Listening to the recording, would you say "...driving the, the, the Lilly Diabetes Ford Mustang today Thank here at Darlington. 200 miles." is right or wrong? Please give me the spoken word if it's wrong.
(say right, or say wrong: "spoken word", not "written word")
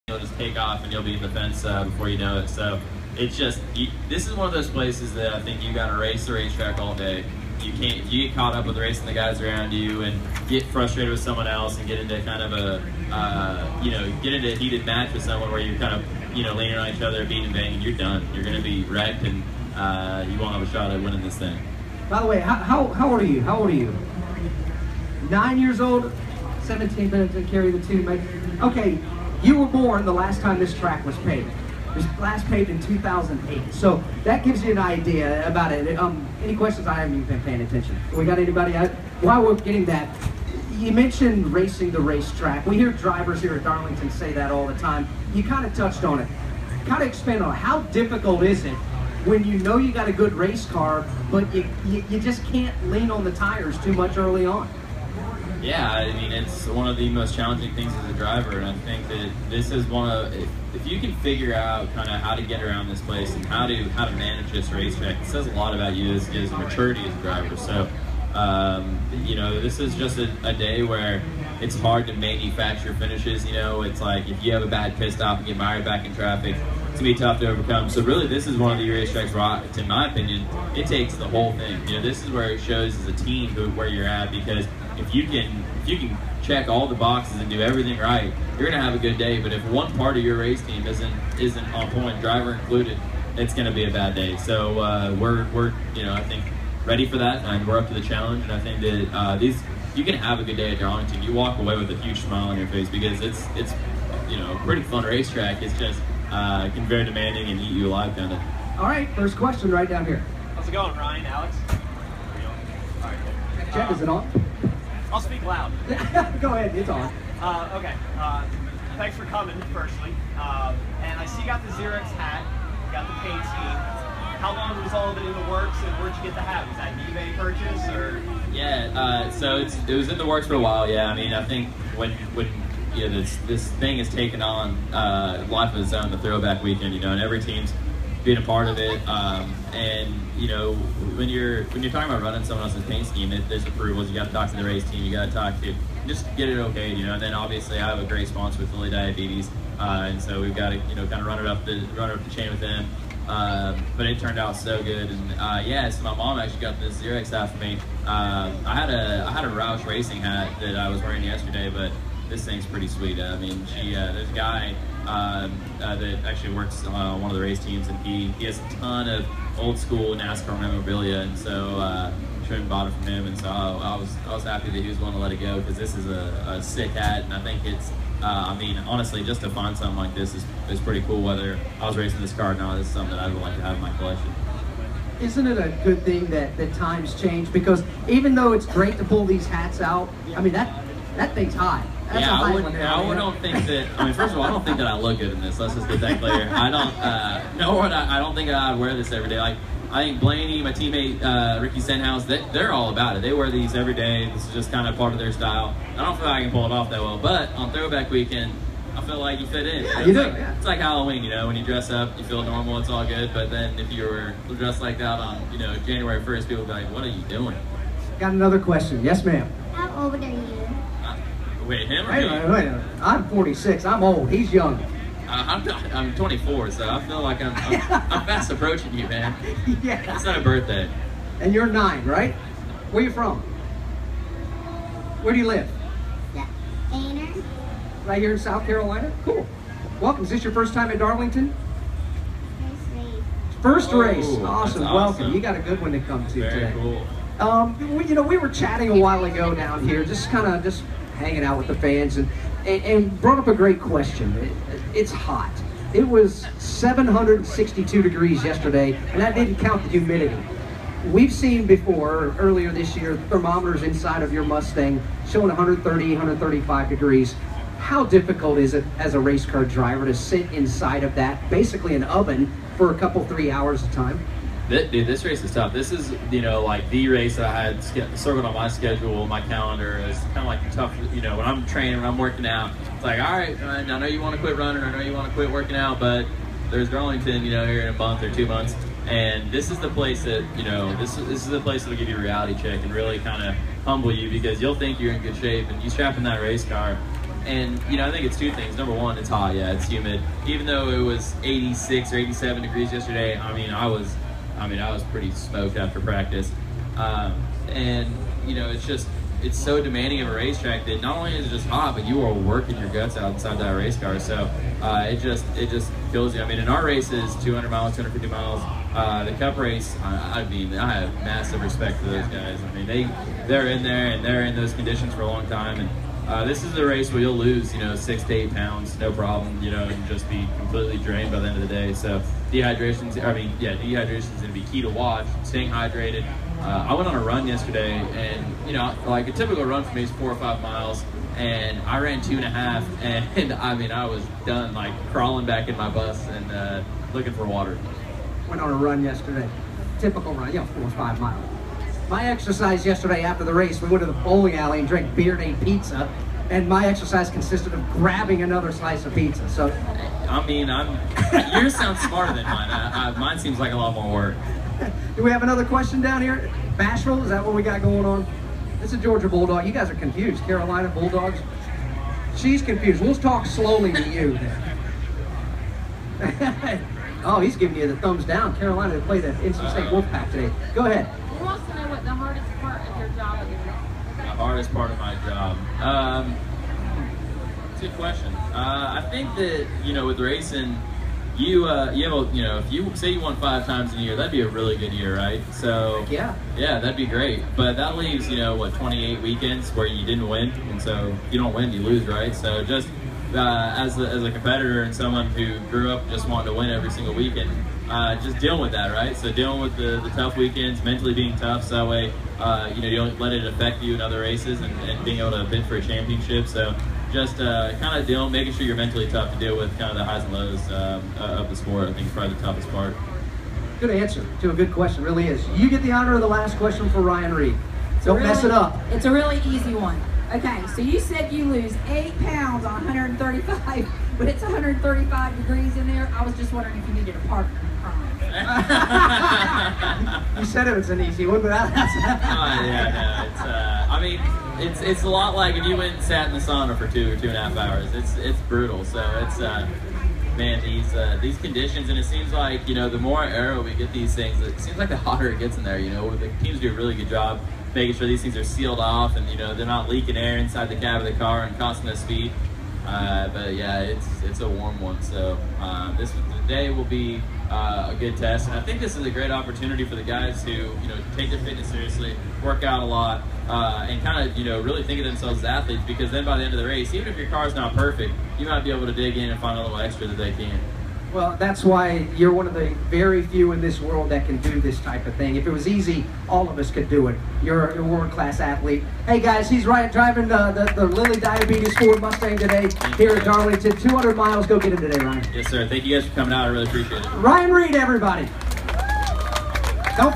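right.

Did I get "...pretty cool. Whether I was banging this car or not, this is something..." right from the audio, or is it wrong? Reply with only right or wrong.
wrong.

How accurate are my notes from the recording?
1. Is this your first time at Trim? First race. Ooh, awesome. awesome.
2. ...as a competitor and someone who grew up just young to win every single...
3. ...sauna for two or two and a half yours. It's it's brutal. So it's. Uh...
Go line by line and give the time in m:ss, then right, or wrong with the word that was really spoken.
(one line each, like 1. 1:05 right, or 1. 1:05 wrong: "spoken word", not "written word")
1. 4:00 wrong: "Darlington", not "Trim"
2. 6:44 wrong: "wanting", not "young"
3. 7:26 wrong: "hours", not "yours".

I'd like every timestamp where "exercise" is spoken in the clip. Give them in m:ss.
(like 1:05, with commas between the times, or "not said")
5:52, 5:56.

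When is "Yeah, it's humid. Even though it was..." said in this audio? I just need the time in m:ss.
4:59.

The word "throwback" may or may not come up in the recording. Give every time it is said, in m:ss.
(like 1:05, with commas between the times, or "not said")
2:16, 3:27.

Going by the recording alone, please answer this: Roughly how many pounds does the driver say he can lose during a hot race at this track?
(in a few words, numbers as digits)
6 to 8 pounds.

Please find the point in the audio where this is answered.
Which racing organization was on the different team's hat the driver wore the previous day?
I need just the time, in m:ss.
2:39.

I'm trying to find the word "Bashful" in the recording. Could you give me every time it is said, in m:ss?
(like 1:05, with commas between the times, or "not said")
6:06.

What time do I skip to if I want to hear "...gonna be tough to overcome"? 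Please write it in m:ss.
1:17.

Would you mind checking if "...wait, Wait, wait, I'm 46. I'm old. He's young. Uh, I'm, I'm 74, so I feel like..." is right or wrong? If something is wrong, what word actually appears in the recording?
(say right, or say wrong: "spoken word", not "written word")
wrong: "24", not "74".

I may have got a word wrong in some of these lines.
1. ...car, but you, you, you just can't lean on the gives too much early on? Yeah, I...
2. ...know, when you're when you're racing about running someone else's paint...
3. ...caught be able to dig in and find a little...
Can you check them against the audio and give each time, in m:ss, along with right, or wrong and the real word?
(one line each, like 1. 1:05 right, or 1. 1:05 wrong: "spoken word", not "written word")
1. 0:50 wrong: "tires", not "gives"
2. 2:20 wrong: "talking", not "racing"
3. 7:58 wrong: "might", not "caught".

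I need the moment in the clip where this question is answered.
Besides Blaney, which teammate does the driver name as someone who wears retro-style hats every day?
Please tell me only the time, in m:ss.
3:21.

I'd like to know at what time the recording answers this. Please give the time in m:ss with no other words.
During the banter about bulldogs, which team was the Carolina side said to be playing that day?
6:19.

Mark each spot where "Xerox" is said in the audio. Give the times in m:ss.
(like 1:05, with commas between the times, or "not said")
2:01, 2:37.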